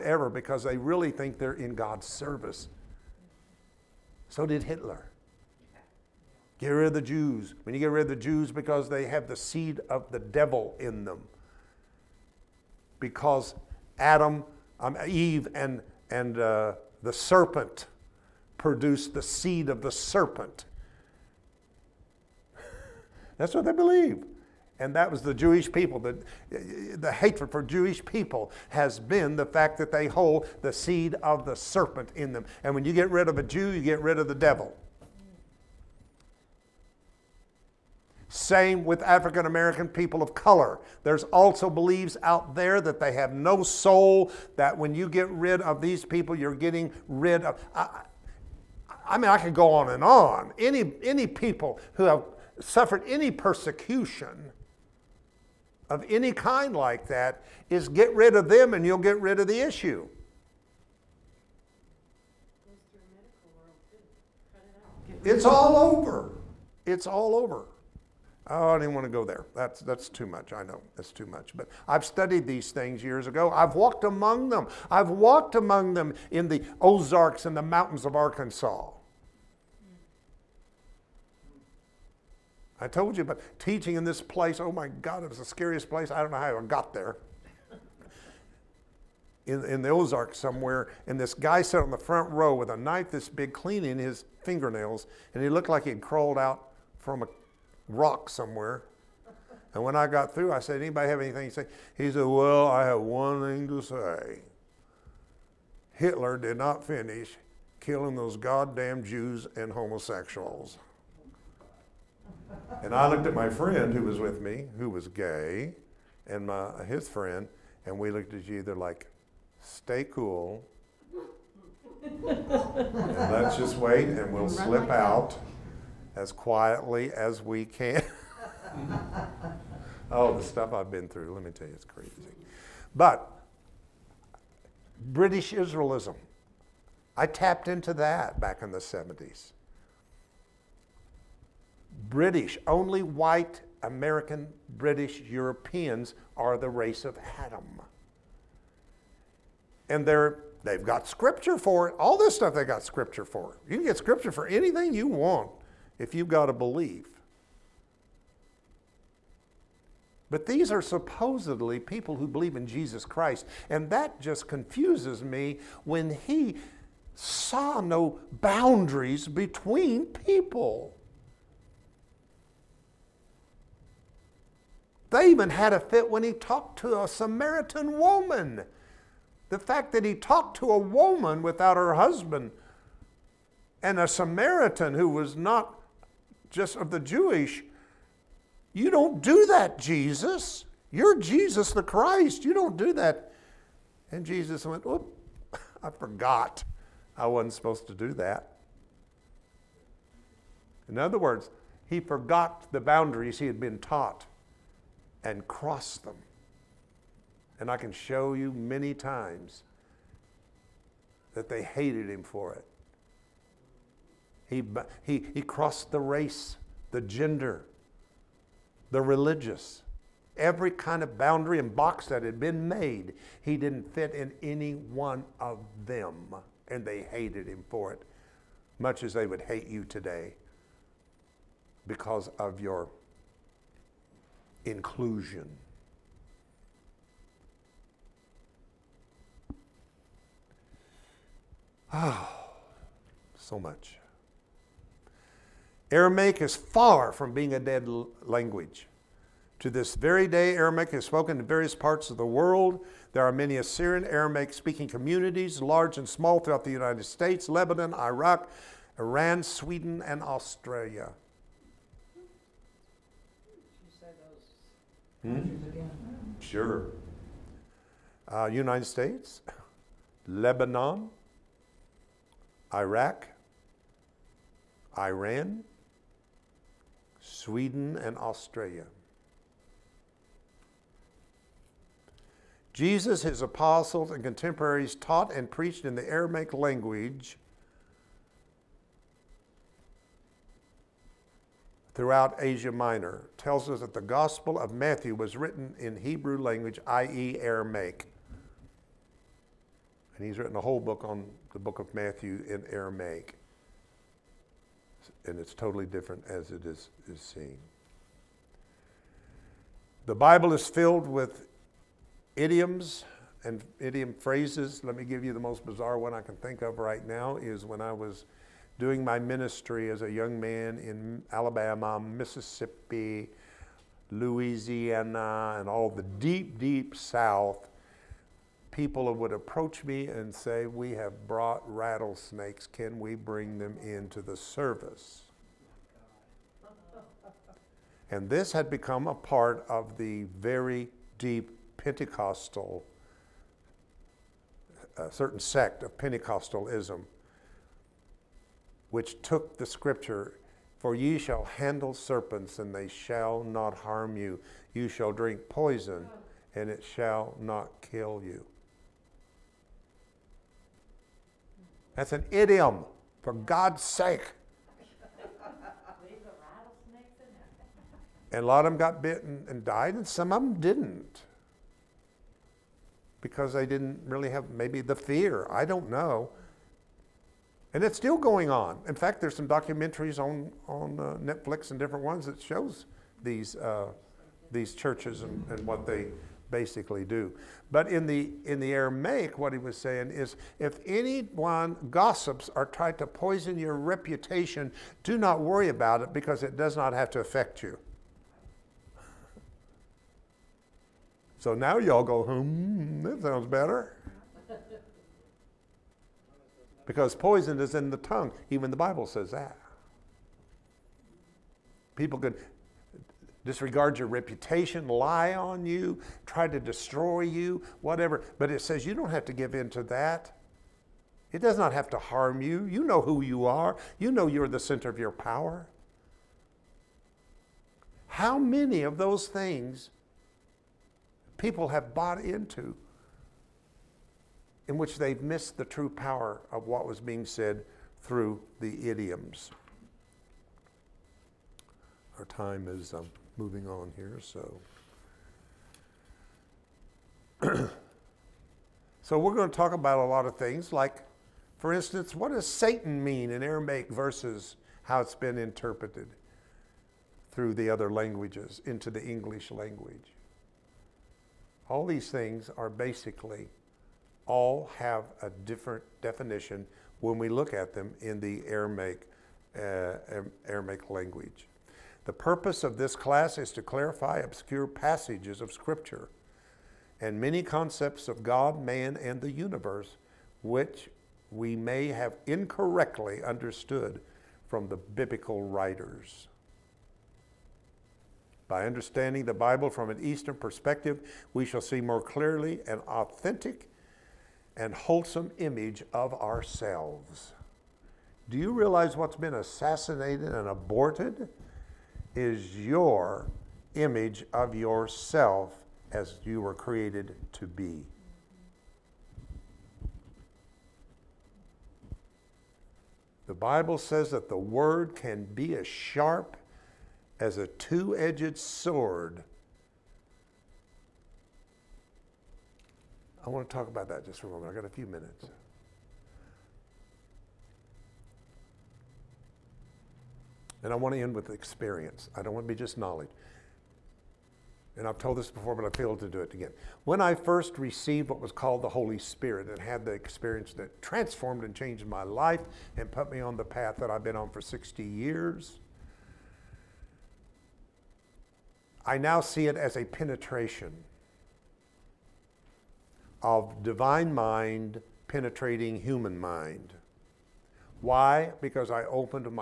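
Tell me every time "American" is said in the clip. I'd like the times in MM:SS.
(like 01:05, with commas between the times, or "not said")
00:39, 02:23.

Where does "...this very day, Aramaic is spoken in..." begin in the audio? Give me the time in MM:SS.
04:09.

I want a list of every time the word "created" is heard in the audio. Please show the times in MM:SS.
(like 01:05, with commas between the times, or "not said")
08:26.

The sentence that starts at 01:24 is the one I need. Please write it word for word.
Oh my God, it was the scariest place.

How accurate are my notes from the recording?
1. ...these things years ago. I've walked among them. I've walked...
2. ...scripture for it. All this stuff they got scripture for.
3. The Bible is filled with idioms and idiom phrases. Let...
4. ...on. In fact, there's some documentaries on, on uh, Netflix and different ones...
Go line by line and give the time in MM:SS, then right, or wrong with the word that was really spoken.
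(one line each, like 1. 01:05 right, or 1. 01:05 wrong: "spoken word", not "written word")
1. 01:12 right
2. 02:31 right
3. 05:10 right
4. 06:18 right.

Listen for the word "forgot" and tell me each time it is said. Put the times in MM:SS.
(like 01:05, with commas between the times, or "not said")
03:15, 03:21.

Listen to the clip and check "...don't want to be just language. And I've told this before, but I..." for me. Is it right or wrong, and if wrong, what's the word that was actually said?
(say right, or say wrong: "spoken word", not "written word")
wrong: "knowledge", not "language".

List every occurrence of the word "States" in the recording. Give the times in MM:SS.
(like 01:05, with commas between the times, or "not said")
04:17, 04:28.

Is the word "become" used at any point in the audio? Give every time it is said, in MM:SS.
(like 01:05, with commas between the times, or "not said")
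05:38.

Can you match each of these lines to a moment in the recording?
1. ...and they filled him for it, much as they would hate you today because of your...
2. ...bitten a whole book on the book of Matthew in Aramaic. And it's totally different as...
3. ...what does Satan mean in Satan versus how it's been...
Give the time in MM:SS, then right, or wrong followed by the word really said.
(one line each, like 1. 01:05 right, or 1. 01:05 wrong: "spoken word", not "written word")
1. 03:46 wrong: "hated", not "filled"
2. 05:00 wrong: "written", not "bitten"
3. 07:32 wrong: "Aramaic", not "Satan".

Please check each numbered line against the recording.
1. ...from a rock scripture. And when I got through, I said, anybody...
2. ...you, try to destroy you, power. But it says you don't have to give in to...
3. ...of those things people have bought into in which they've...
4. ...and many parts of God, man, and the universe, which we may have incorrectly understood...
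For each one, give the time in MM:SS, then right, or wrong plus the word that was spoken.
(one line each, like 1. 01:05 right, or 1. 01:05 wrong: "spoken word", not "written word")
1. 01:36 wrong: "somewhere", not "scripture"
2. 06:55 wrong: "whatever", not "power"
3. 07:08 right
4. 07:56 wrong: "concepts", not "parts".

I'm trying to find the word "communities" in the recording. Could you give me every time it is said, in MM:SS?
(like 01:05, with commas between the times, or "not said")
04:14.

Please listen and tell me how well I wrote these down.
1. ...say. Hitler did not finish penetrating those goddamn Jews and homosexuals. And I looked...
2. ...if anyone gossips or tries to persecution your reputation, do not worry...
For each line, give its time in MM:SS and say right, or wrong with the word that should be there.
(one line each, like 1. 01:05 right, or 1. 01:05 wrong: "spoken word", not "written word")
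1. 01:43 wrong: "killing", not "penetrating"
2. 06:30 wrong: "poison", not "persecution".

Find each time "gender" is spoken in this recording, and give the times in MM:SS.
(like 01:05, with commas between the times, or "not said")
03:36.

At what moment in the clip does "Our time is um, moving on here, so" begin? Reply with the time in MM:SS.
07:22.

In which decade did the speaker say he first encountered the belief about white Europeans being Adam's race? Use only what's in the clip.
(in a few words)
The 70s.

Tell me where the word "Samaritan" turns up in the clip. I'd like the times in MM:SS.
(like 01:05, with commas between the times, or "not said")
02:57, 03:04.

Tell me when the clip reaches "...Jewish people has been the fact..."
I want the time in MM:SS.
00:27.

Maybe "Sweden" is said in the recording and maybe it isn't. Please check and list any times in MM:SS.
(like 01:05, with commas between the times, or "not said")
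04:19, 04:37.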